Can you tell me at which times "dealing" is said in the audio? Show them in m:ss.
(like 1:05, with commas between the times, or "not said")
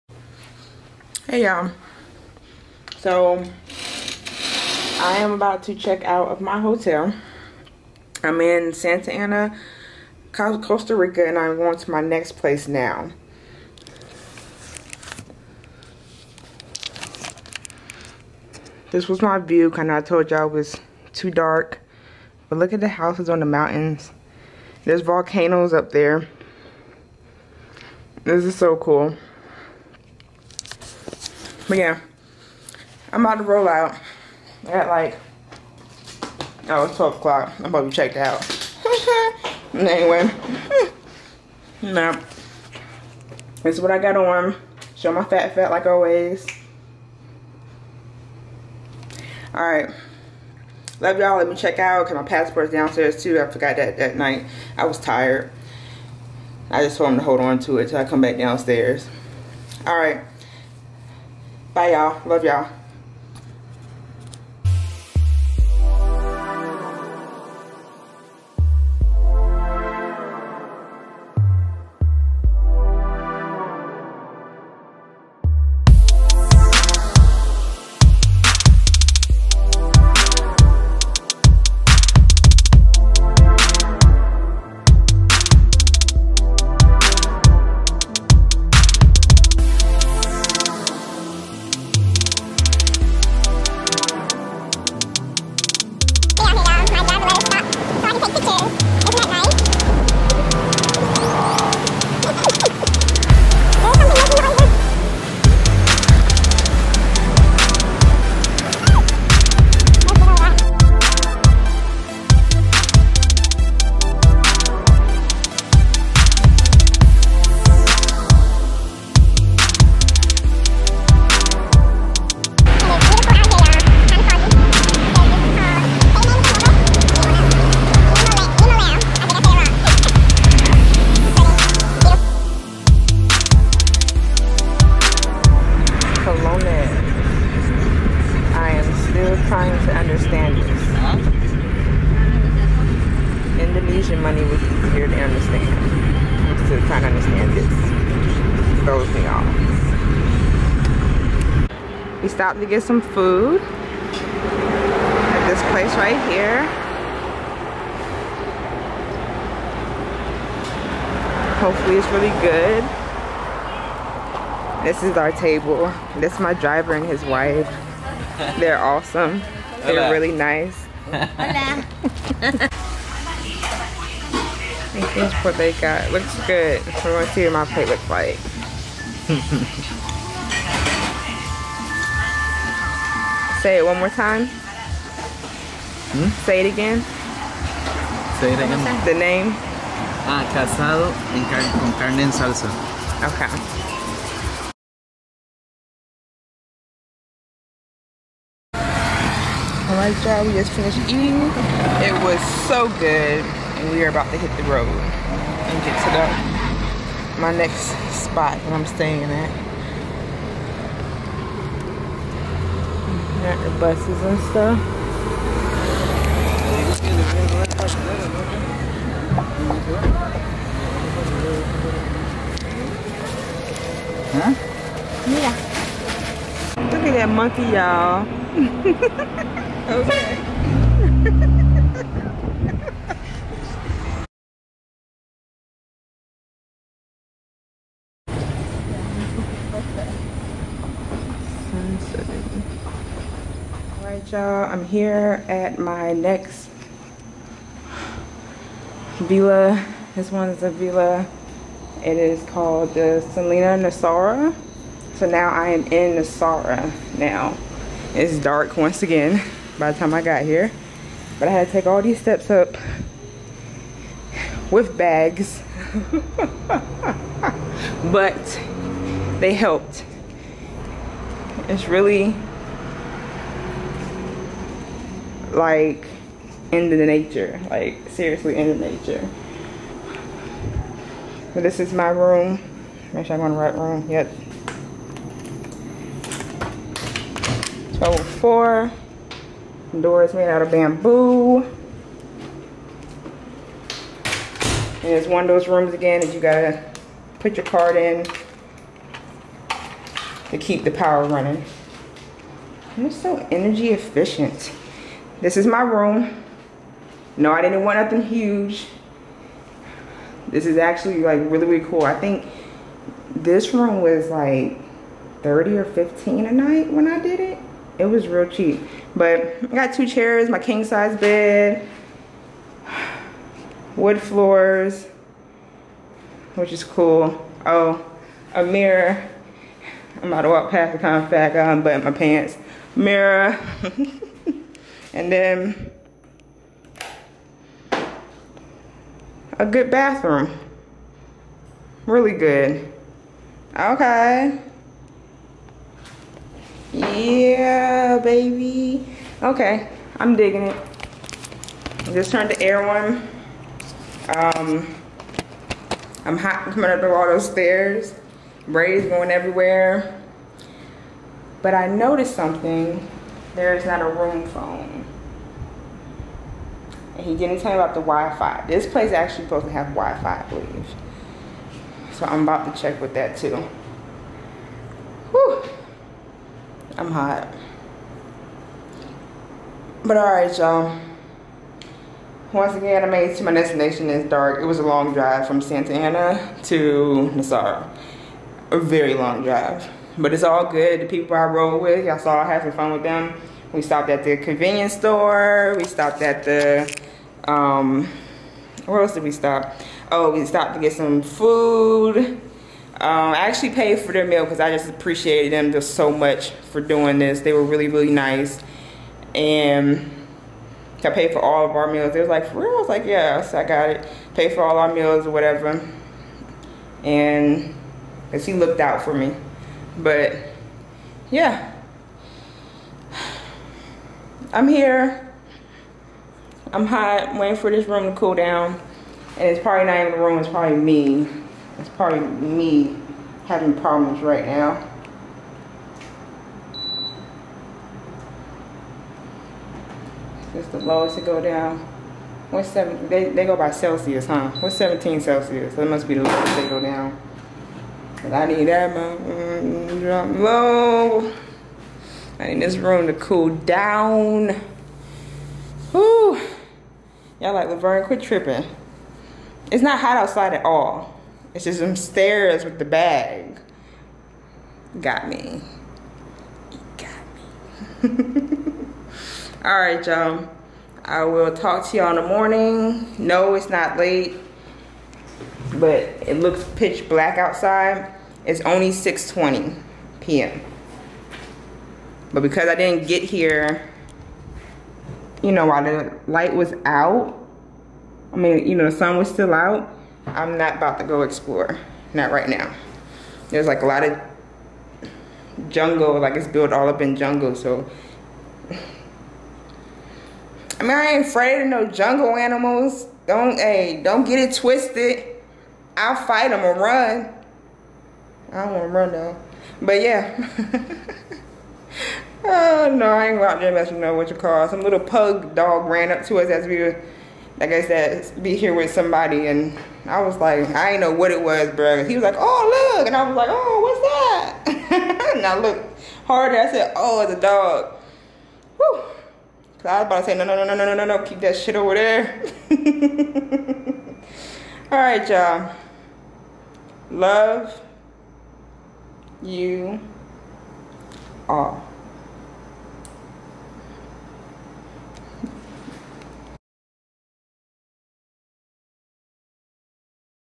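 not said.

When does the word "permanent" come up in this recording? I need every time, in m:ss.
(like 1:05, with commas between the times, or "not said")
not said.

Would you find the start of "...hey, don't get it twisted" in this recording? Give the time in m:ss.
8:23.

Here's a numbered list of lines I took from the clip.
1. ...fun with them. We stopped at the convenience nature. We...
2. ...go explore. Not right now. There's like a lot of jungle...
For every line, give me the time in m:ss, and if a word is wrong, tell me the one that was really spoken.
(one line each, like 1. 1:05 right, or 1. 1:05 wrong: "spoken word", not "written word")
1. 6:32 wrong: "store", not "nature"
2. 8:11 right.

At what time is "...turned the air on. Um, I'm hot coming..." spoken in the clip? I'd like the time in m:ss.
5:52.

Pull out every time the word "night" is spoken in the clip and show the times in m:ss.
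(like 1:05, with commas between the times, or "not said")
0:54, 5:16.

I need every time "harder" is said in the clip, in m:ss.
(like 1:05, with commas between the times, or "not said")
8:46.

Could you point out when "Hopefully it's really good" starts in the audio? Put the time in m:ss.
2:41.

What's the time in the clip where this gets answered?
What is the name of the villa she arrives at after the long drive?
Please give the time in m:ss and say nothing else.
4:13.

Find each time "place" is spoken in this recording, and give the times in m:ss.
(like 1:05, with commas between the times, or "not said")
0:12, 2:35, 6:08.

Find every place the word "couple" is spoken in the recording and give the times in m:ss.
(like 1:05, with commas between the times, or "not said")
not said.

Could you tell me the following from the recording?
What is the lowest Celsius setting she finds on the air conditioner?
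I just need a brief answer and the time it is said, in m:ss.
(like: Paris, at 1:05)
17, at 7:24.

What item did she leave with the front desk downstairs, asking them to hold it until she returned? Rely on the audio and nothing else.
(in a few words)
Passport.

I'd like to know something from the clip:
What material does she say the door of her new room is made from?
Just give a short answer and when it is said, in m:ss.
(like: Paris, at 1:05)
Bamboo, at 4:50.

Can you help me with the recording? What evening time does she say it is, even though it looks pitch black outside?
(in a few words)
6:20 p.m.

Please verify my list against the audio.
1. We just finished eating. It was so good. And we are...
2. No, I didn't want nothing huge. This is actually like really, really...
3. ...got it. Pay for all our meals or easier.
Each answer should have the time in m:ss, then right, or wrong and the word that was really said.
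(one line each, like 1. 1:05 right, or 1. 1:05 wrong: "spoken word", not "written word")
1. 3:20 right
2. 5:07 right
3. 6:53 wrong: "whatever", not "easier".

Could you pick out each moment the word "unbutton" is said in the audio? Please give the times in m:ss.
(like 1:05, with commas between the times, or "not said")
5:31.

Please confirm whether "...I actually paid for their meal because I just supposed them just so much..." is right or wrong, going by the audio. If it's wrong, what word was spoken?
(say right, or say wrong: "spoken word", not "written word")
wrong: "appreciated", not "supposed".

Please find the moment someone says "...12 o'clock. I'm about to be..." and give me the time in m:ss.
0:36.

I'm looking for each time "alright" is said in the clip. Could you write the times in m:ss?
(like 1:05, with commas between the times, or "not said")
0:49, 0:59, 4:03, 6:20.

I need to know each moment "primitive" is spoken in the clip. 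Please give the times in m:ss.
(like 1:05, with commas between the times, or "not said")
not said.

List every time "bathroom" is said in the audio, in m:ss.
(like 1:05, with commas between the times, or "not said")
5:39.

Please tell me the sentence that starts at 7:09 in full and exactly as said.
And it's probably not even the room, it's probably me.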